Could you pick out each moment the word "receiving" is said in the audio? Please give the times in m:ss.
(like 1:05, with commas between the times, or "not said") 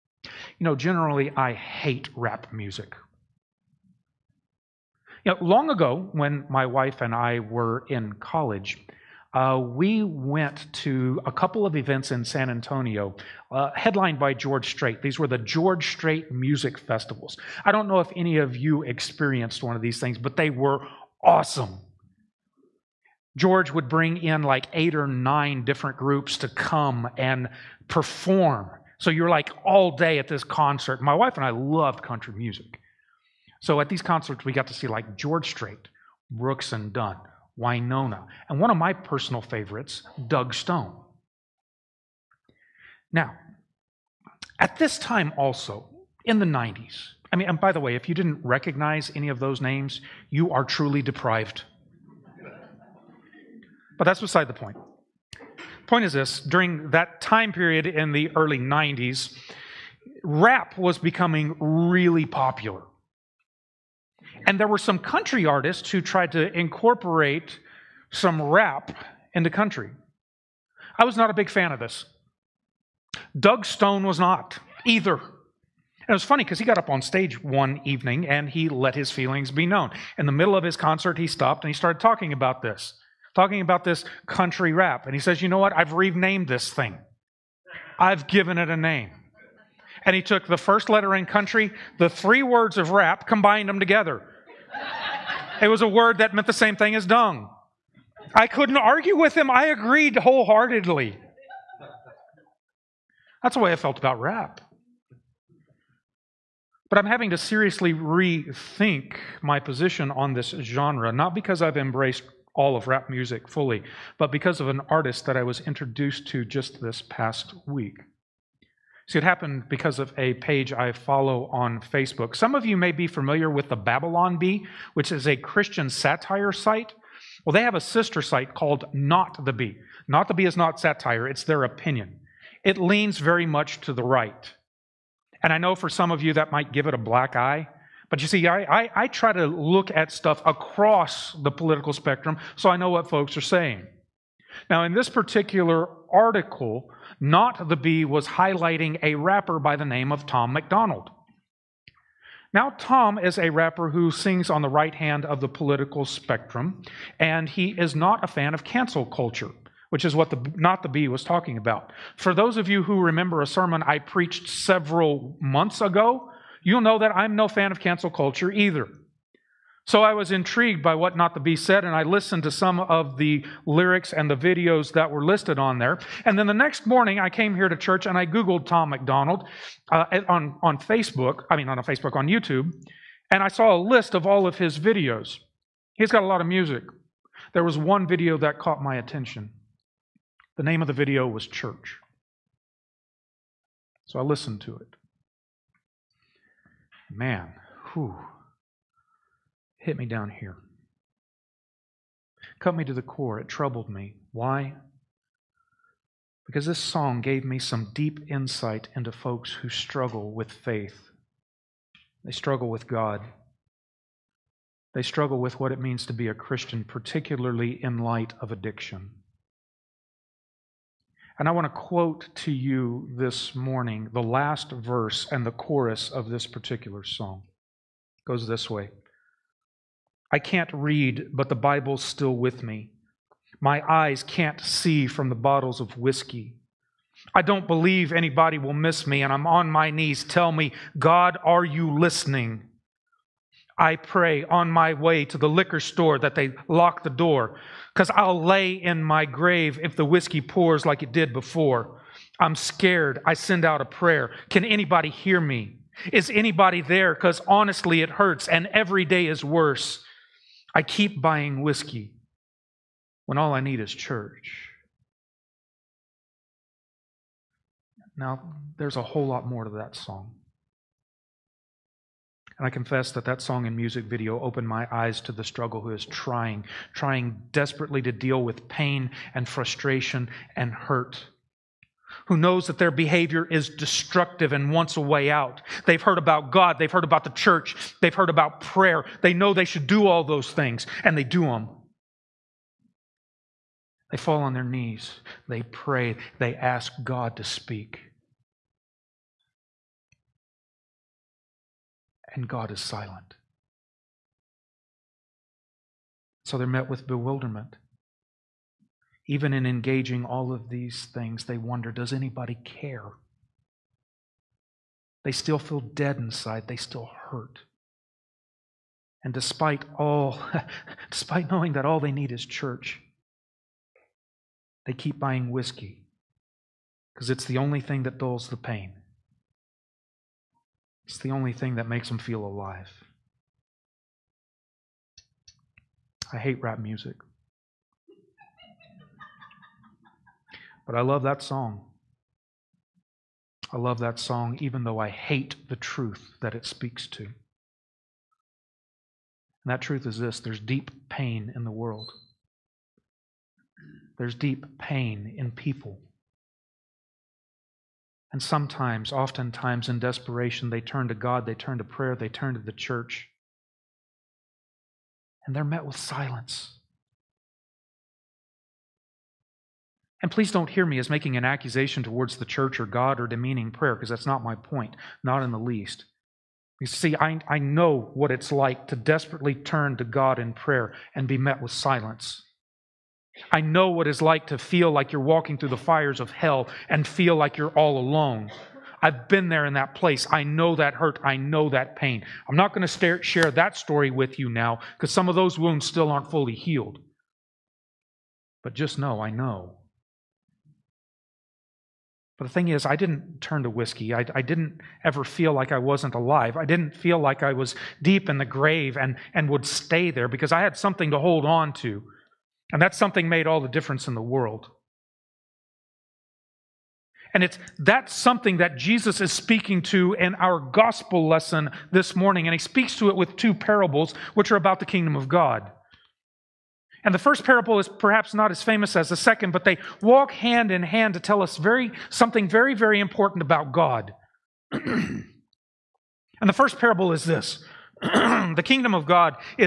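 not said.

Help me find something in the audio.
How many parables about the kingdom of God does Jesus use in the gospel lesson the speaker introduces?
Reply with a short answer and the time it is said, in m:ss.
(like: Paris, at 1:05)
2, at 7:03.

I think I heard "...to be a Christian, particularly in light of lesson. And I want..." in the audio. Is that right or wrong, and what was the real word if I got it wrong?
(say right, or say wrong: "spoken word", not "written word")
wrong: "addiction", not "lesson".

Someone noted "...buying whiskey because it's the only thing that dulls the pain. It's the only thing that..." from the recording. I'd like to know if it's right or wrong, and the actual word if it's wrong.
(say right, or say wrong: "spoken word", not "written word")
right.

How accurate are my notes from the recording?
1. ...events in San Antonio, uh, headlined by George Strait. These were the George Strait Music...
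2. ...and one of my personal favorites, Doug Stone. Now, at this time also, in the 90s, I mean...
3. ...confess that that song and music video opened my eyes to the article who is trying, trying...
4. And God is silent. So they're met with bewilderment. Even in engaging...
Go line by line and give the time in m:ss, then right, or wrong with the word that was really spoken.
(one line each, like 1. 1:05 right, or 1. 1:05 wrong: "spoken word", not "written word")
1. 0:11 right
2. 0:38 right
3. 4:32 wrong: "struggle", not "article"
4. 5:02 right.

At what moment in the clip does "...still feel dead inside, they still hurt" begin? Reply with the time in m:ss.
5:15.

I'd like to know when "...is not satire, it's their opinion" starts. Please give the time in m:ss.
2:10.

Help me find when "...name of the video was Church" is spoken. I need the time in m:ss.
3:10.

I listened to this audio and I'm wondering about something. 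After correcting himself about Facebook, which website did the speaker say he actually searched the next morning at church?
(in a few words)
YouTube.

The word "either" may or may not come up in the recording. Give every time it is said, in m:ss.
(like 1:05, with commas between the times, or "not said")
1:14, 2:48.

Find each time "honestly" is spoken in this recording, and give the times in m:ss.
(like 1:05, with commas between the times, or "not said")
4:17.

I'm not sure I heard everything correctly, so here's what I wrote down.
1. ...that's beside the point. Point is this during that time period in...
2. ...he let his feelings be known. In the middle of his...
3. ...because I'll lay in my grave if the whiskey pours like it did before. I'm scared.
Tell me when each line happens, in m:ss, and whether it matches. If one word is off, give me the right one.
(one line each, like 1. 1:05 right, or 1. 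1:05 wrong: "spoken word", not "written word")
1. 0:54 right
2. 1:18 right
3. 4:07 right.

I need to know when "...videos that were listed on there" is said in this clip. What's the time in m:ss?
2:54.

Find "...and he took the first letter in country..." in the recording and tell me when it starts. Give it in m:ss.
1:30.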